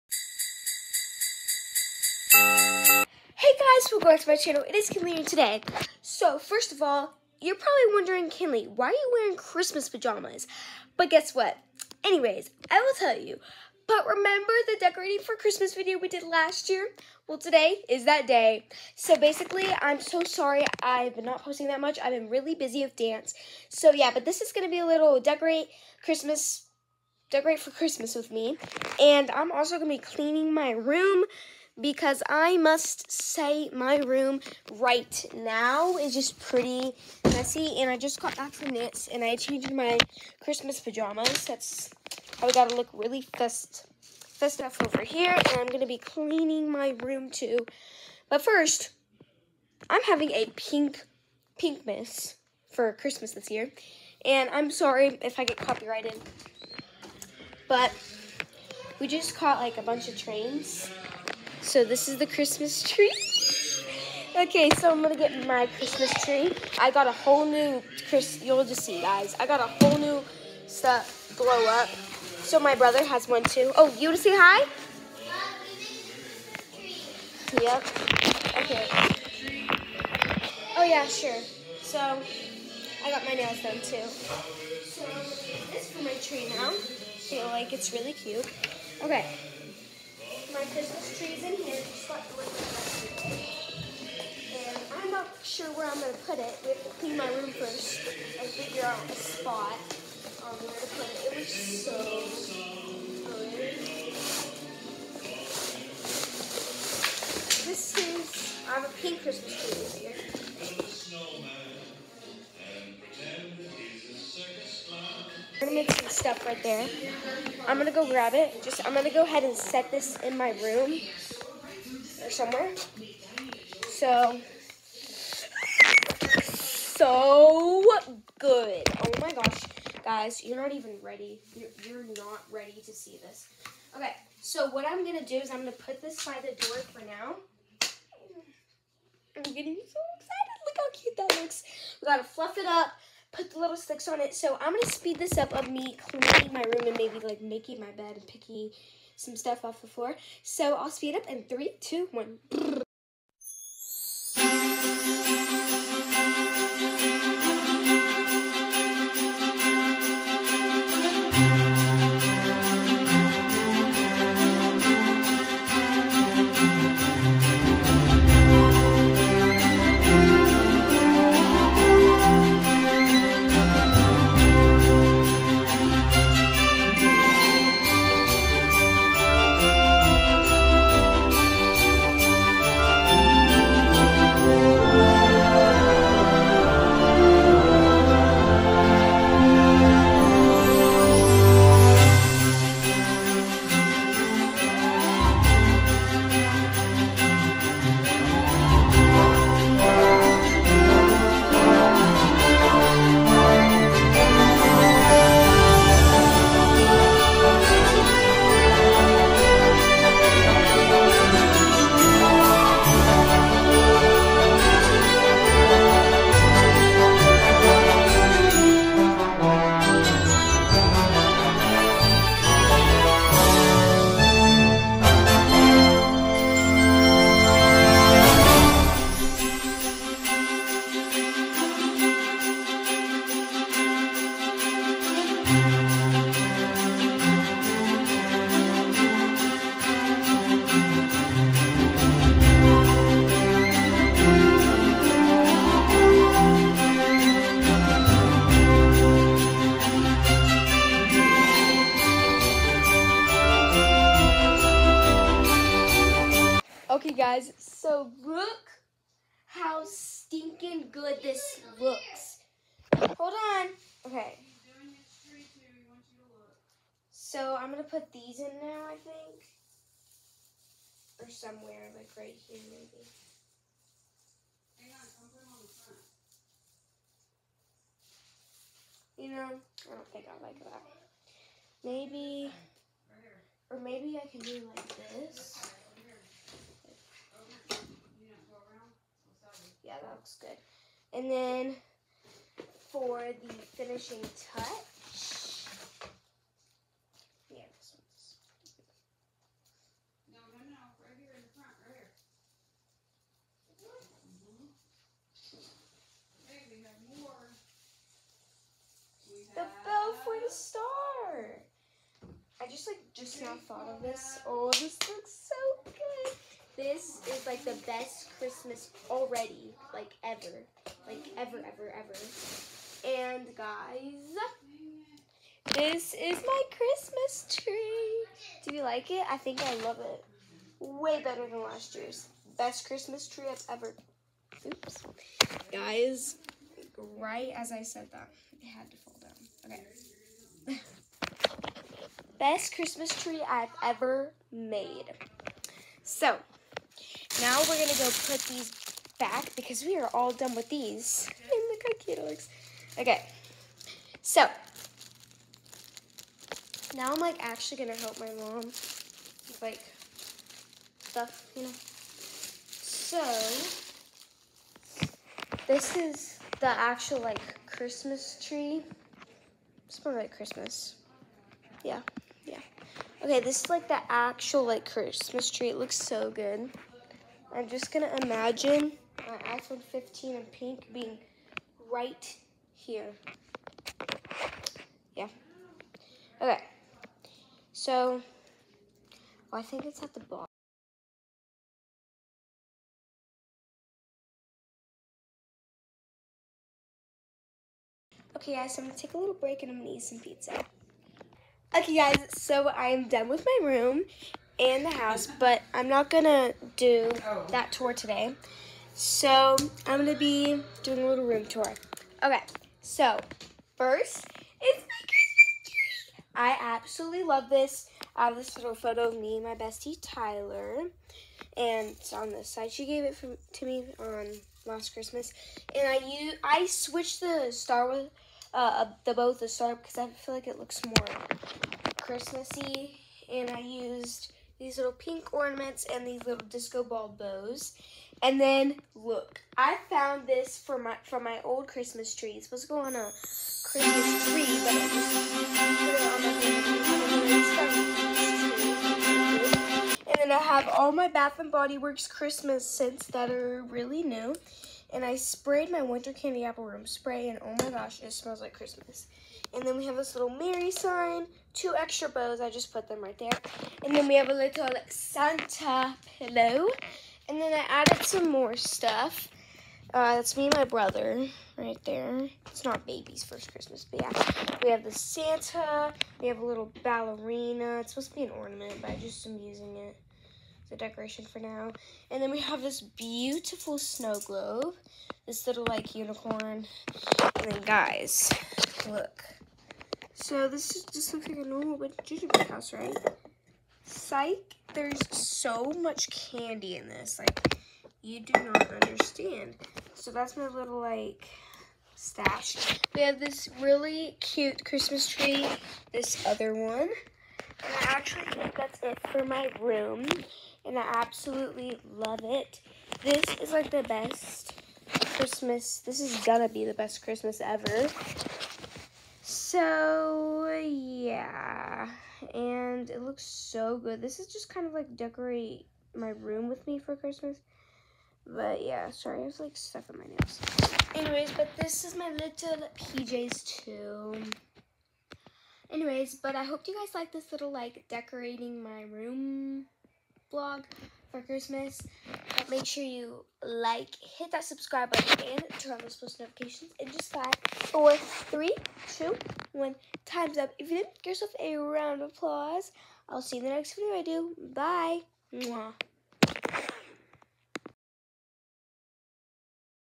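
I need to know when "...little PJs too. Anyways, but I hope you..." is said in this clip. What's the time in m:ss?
8:52.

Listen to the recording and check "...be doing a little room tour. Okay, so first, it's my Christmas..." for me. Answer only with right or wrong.
right.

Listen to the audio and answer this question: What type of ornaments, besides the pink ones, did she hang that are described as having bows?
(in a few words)
Disco ball bows.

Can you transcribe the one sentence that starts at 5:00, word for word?
No, no, no, right here in the front, right here.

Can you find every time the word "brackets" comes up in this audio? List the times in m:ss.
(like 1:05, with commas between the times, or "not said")
not said.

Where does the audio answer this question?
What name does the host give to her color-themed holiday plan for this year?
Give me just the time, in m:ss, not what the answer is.
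0:51.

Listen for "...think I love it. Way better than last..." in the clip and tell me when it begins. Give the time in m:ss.
5:29.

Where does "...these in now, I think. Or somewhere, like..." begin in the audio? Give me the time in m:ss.
4:28.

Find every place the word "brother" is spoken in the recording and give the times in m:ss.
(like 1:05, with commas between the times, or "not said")
1:12, 7:50.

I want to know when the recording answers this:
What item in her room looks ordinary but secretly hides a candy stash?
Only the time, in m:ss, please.
8:12.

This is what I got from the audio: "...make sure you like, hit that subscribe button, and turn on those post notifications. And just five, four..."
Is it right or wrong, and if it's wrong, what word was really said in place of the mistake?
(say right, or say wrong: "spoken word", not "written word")
right.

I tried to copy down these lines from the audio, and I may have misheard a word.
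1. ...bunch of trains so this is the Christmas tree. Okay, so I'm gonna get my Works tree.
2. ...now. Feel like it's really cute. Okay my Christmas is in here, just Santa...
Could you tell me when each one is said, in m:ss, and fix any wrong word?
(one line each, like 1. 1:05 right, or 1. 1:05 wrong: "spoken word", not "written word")
1. 0:59 wrong: "Christmas", not "Works"
2. 1:26 wrong: "And", not "Santa".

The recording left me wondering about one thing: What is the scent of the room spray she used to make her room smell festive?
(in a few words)
Winter candy apple.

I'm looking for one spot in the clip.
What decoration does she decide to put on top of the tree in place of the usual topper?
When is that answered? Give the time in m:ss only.
5:09.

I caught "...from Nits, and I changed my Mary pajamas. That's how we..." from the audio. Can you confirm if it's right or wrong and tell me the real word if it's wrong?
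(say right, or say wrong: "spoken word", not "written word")
wrong: "Christmas", not "Mary".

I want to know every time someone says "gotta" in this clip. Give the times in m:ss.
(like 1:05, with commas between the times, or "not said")
0:42, 2:22.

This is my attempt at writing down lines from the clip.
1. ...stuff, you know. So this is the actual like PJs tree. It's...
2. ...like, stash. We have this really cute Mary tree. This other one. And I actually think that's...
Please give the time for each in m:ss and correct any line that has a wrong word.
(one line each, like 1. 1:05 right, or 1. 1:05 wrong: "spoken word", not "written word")
1. 6:00 wrong: "Christmas", not "PJs"
2. 8:20 wrong: "Christmas", not "Mary".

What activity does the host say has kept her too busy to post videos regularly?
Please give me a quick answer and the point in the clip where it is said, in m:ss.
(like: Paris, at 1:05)
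Dance, at 0:22.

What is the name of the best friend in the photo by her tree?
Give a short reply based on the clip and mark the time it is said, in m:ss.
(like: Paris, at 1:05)
Tyler, at 7:00.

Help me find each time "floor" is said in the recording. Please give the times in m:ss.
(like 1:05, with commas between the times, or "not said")
2:29.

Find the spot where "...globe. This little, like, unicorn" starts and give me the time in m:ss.
8:04.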